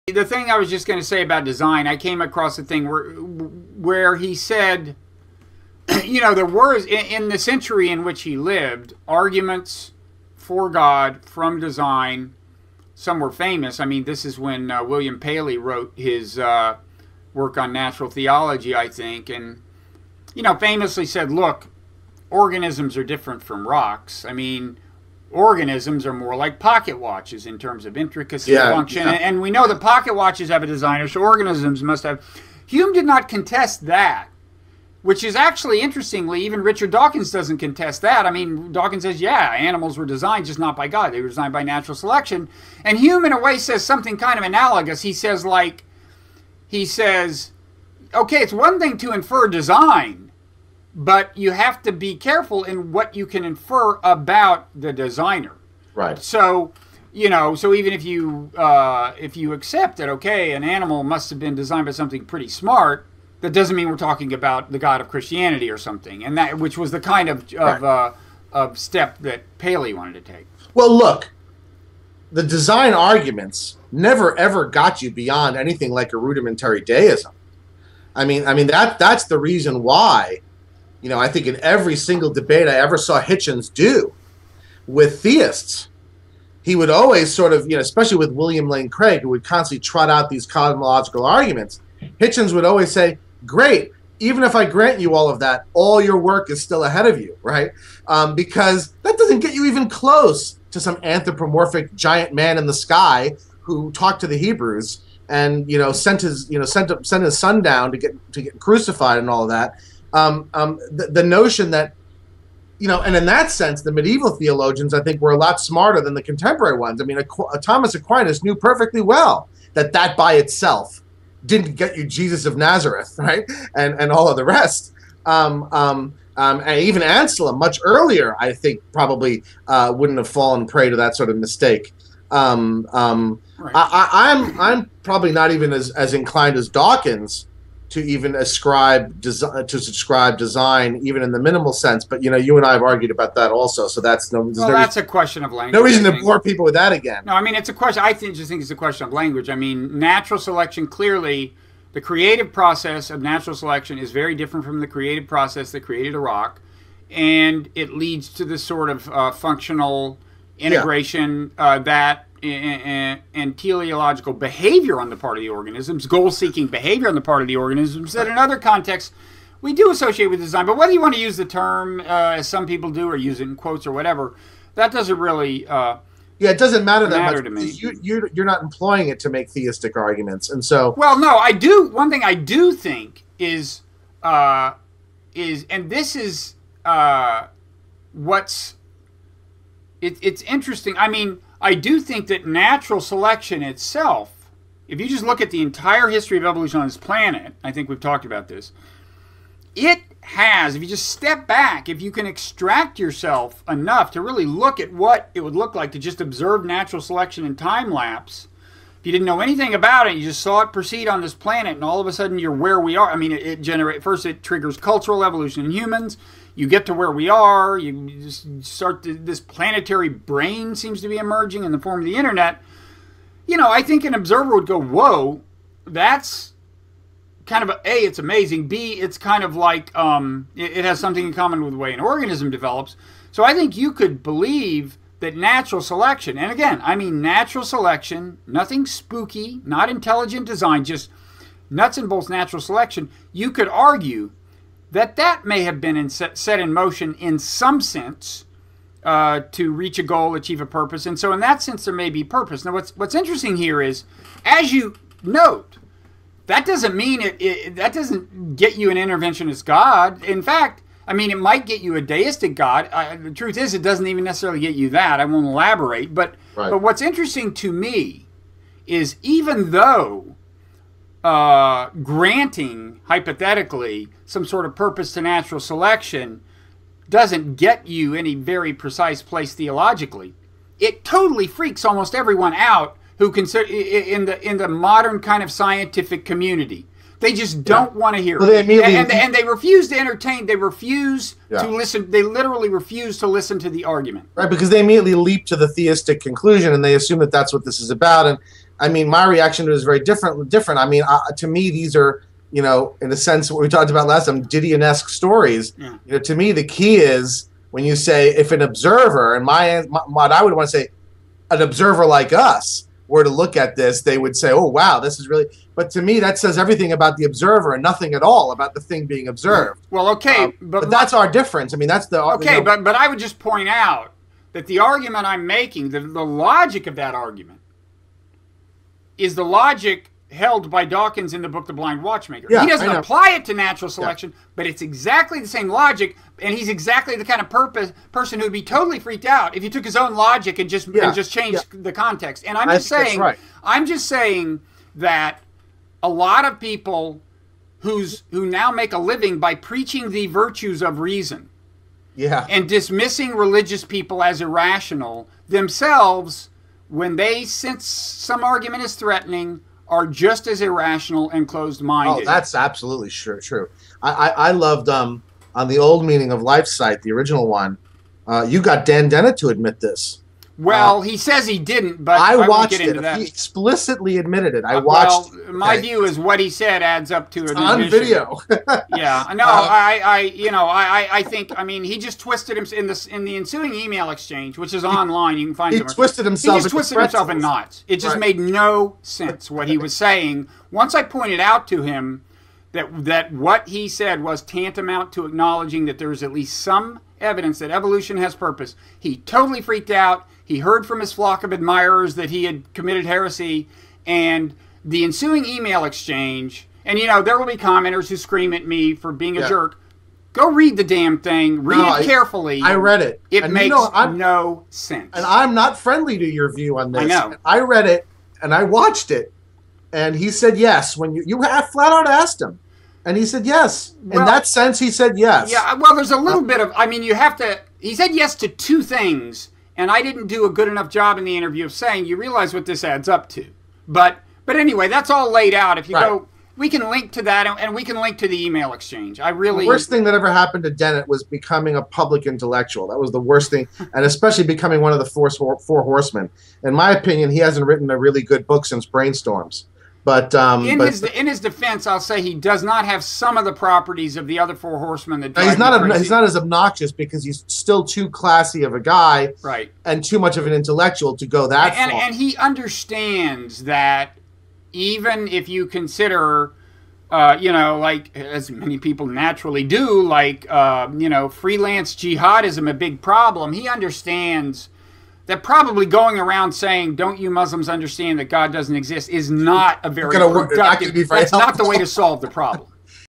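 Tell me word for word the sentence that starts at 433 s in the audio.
But, but anyway, that's all laid out.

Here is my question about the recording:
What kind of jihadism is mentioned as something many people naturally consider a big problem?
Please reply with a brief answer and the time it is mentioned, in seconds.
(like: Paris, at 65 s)
freelance jihadism, at 471 s.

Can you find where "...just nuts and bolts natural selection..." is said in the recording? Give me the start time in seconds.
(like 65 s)
240 s.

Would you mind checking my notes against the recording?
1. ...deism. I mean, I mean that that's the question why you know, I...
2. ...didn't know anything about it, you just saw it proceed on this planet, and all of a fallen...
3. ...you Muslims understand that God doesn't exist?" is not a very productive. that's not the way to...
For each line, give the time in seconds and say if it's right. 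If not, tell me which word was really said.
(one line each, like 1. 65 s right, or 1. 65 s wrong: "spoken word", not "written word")
1. 76 s wrong: "reason", not "question"
2. 209 s wrong: "sudden", not "fallen"
3. 477 s right.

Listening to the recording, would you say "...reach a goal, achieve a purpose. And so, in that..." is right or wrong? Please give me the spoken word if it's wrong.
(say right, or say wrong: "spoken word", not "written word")
right.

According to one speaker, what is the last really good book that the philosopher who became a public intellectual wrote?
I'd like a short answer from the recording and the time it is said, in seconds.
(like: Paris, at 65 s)
Brainstorms, at 448 s.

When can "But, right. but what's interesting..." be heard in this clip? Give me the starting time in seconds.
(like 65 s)
266 s.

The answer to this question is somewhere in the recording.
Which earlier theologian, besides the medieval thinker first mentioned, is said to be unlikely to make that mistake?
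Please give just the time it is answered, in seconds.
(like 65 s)
127 s.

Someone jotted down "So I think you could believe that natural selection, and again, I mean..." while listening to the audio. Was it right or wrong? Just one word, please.
right.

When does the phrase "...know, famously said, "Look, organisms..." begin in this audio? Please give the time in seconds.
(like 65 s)
20 s.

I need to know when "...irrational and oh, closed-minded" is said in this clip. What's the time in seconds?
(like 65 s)
360 s.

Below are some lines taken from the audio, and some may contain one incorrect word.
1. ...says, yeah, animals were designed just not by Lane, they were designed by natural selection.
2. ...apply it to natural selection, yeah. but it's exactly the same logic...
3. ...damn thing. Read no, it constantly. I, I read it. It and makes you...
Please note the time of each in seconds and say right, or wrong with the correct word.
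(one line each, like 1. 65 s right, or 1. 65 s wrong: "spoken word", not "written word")
1. 39 s wrong: "God", not "Lane"
2. 332 s right
3. 410 s wrong: "carefully", not "constantly".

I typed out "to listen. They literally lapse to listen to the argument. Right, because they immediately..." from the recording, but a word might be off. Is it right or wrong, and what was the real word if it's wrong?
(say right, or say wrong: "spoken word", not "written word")
wrong: "refuse", not "lapse".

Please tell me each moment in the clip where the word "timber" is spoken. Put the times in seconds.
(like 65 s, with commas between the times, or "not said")
not said.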